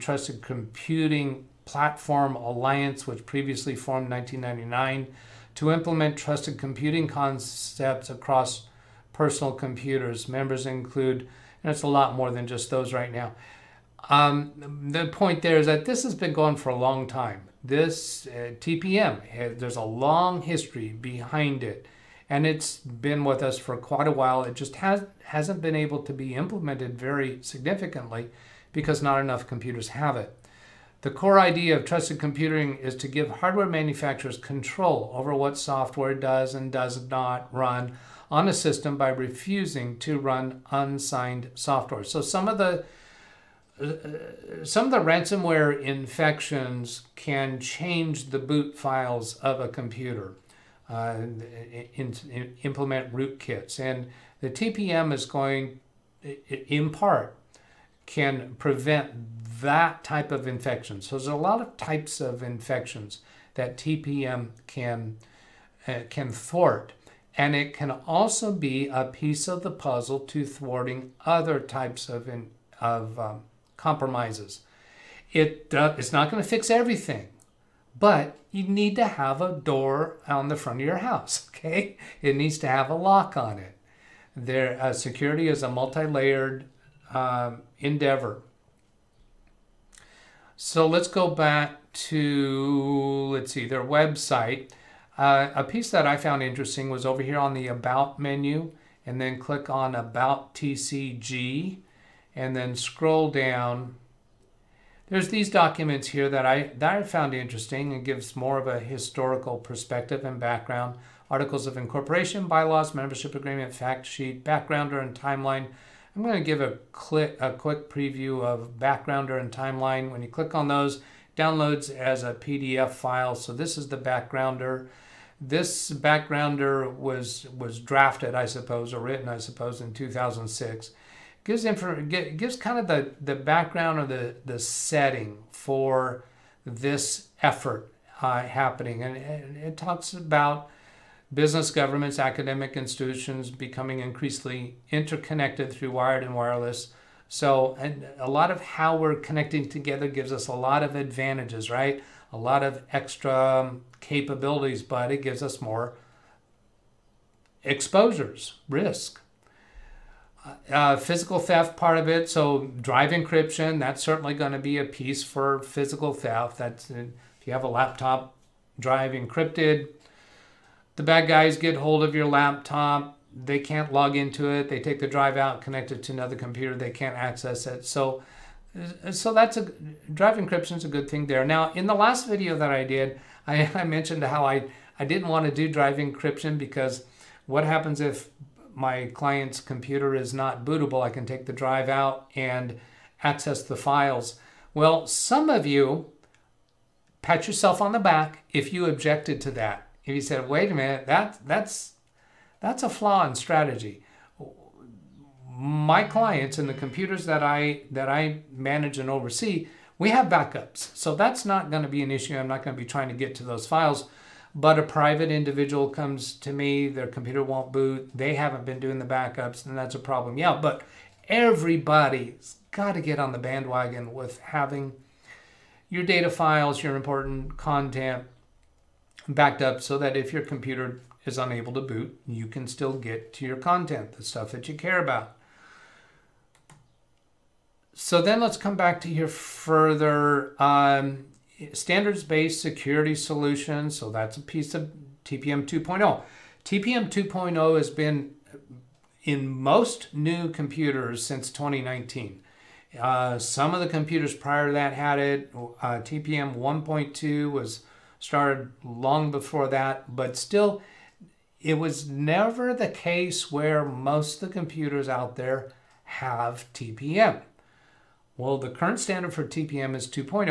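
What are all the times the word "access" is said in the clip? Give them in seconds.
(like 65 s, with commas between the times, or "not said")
177 s, 193 s.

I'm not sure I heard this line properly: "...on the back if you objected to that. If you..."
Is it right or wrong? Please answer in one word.
right.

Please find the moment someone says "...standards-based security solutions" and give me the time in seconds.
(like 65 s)
241 s.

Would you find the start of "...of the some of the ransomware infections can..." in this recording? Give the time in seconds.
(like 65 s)
42 s.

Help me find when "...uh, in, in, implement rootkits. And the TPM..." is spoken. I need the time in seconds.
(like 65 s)
50 s.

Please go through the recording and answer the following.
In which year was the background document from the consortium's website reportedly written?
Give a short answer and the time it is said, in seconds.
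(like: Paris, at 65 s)
2006, at 129 s.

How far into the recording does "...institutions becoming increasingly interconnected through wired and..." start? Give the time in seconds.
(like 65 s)
142 s.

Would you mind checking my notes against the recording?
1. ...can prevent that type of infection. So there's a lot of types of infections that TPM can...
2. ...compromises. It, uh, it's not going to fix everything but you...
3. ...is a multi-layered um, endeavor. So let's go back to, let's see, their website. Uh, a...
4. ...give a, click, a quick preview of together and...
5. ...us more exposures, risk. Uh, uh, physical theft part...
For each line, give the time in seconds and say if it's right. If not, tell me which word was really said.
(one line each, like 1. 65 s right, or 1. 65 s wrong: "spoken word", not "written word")
1. 58 s right
2. 73 s right
3. 85 s right
4. 116 s wrong: "backgrounder", not "together"
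5. 155 s right.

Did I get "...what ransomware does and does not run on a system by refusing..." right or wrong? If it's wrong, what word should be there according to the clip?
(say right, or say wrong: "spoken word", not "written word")
wrong: "software", not "ransomware".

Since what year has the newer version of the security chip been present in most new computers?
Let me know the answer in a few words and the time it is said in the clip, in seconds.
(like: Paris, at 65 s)
2019, at 251 s.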